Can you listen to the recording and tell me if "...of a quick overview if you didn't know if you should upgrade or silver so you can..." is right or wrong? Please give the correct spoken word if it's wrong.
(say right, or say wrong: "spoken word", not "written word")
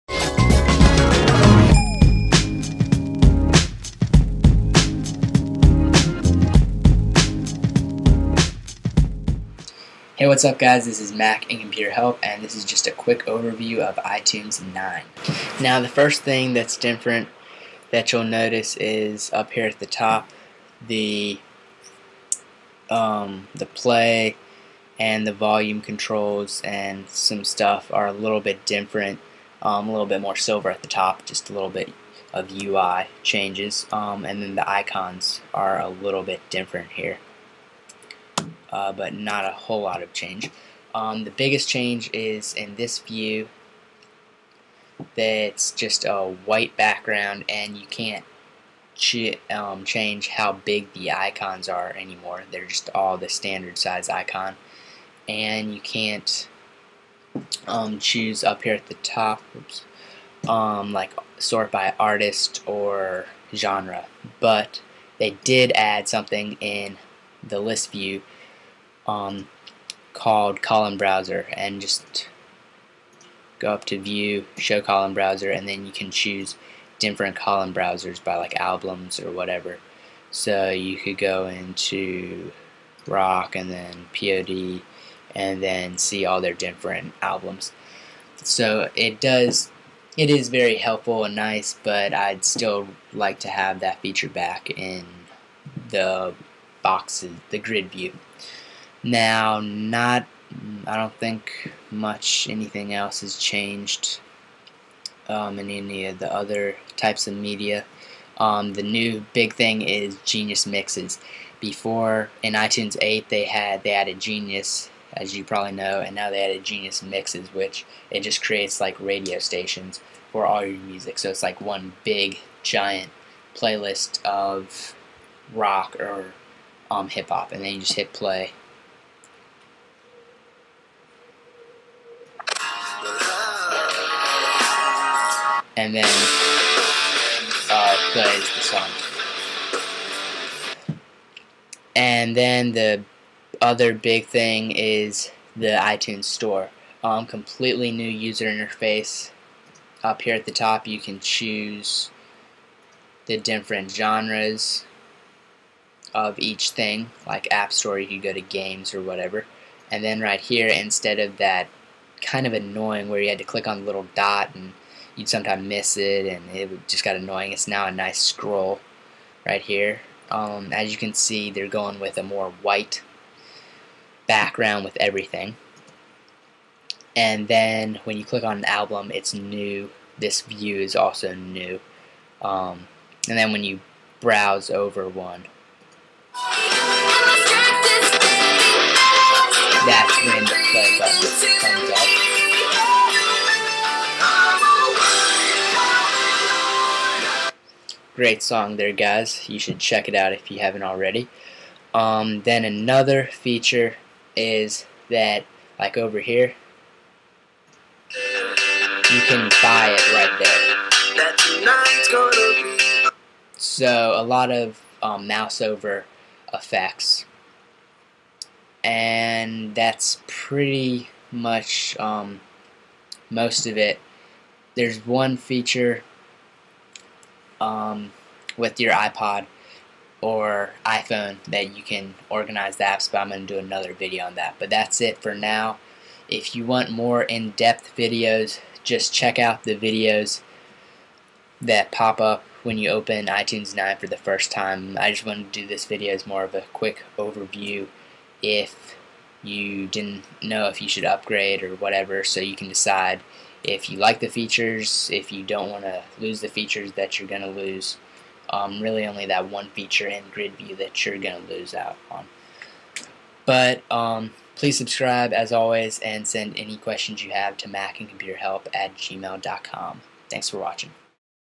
wrong: "whatever", not "silver".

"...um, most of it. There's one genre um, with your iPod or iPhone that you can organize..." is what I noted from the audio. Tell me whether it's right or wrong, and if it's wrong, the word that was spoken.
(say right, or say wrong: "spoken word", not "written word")
wrong: "feature", not "genre".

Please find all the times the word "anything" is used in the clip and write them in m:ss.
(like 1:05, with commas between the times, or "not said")
1:42.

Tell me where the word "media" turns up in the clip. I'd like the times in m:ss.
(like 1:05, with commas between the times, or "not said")
1:47.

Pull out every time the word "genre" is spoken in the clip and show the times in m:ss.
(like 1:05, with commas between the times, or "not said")
1:03, 2:33.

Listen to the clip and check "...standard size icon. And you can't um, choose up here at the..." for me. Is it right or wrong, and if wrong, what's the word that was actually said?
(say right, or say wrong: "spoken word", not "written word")
right.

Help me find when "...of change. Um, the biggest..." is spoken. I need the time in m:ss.
0:40.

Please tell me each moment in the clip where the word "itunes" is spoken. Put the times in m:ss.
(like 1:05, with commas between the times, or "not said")
0:13, 1:52, 2:25, 4:03.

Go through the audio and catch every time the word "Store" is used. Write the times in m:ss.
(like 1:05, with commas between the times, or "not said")
2:26, 2:37.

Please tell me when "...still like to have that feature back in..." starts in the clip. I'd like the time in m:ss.
1:32.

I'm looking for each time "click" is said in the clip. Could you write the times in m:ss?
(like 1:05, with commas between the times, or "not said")
2:43, 2:58.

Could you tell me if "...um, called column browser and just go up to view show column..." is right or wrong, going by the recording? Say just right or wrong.
right.